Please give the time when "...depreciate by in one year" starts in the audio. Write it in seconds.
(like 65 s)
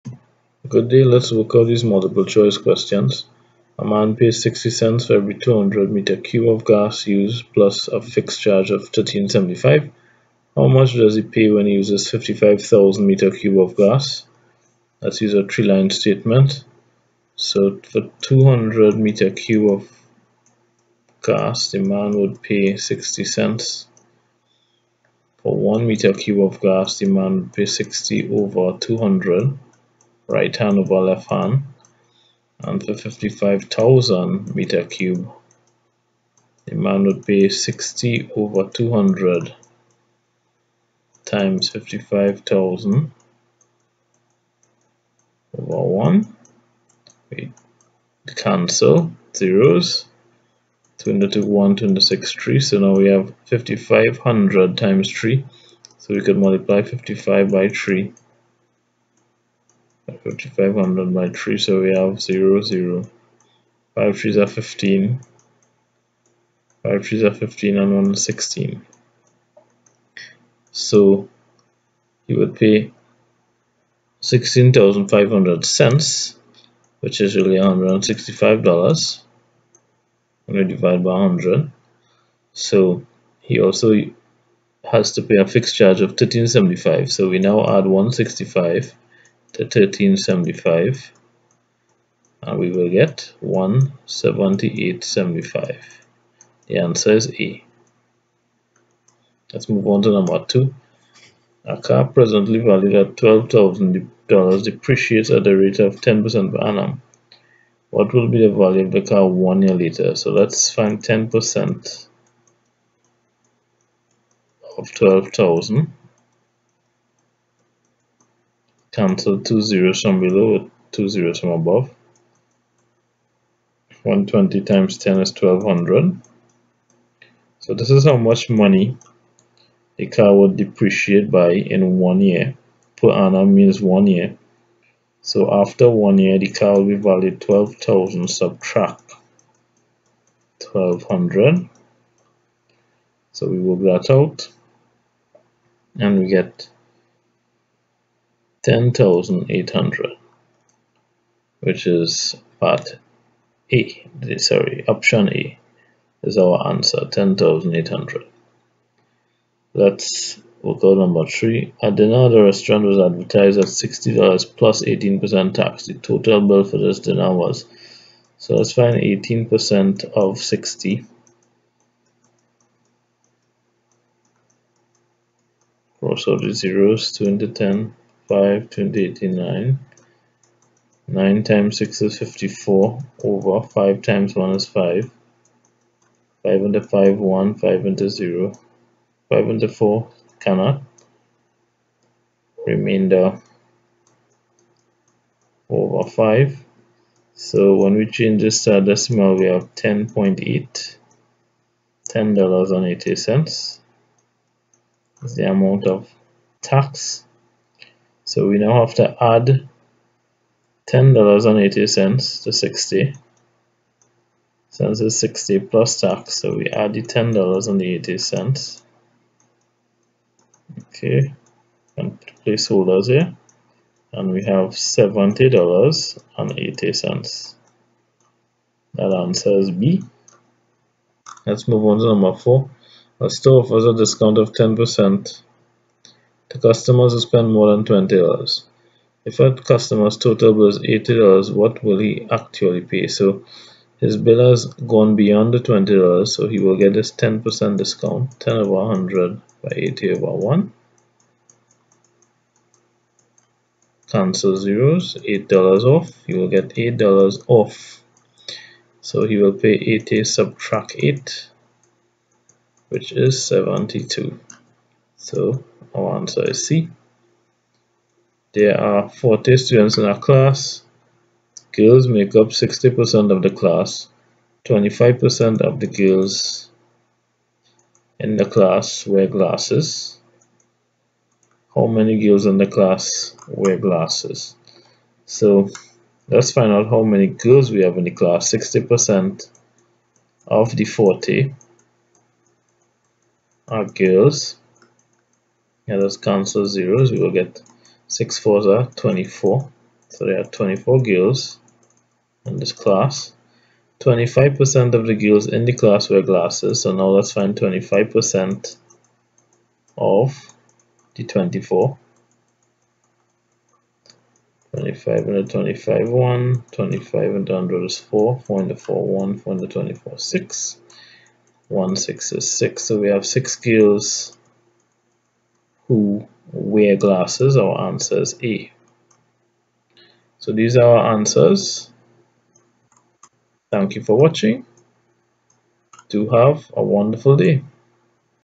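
130 s.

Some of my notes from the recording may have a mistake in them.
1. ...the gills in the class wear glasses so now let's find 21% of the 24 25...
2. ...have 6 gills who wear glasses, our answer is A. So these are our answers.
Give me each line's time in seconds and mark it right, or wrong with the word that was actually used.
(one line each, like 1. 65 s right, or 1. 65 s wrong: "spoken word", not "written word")
1. 305 s wrong: "25", not "21"
2. 323 s right.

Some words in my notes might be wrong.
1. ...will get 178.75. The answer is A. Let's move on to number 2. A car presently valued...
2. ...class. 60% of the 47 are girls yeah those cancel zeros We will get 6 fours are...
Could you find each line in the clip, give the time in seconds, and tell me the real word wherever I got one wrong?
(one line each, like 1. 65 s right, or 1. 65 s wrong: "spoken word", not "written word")
1. 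92 s right
2. 288 s wrong: "40", not "47".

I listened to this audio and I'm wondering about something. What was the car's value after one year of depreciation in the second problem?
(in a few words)
10,800.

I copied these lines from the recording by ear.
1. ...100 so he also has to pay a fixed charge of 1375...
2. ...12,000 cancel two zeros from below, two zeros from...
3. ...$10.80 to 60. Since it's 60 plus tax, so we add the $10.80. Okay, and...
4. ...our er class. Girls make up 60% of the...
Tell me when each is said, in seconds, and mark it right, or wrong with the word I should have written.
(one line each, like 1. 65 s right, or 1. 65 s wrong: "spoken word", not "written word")
1. 81 s right
2. 114 s right
3. 210 s right
4. 270 s right.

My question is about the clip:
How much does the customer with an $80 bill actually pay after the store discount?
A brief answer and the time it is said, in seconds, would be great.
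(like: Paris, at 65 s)
72, at 263 s.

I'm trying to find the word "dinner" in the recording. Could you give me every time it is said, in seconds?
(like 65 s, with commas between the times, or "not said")
161 s, 166 s.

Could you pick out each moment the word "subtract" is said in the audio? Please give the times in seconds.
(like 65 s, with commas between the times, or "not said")
138 s, 260 s.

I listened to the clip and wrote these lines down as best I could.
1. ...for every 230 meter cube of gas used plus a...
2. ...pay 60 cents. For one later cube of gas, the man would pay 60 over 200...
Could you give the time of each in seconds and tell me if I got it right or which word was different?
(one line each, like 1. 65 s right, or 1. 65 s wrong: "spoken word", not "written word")
1. 5 s wrong: "200", not "230"
2. 22 s wrong: "meter", not "later".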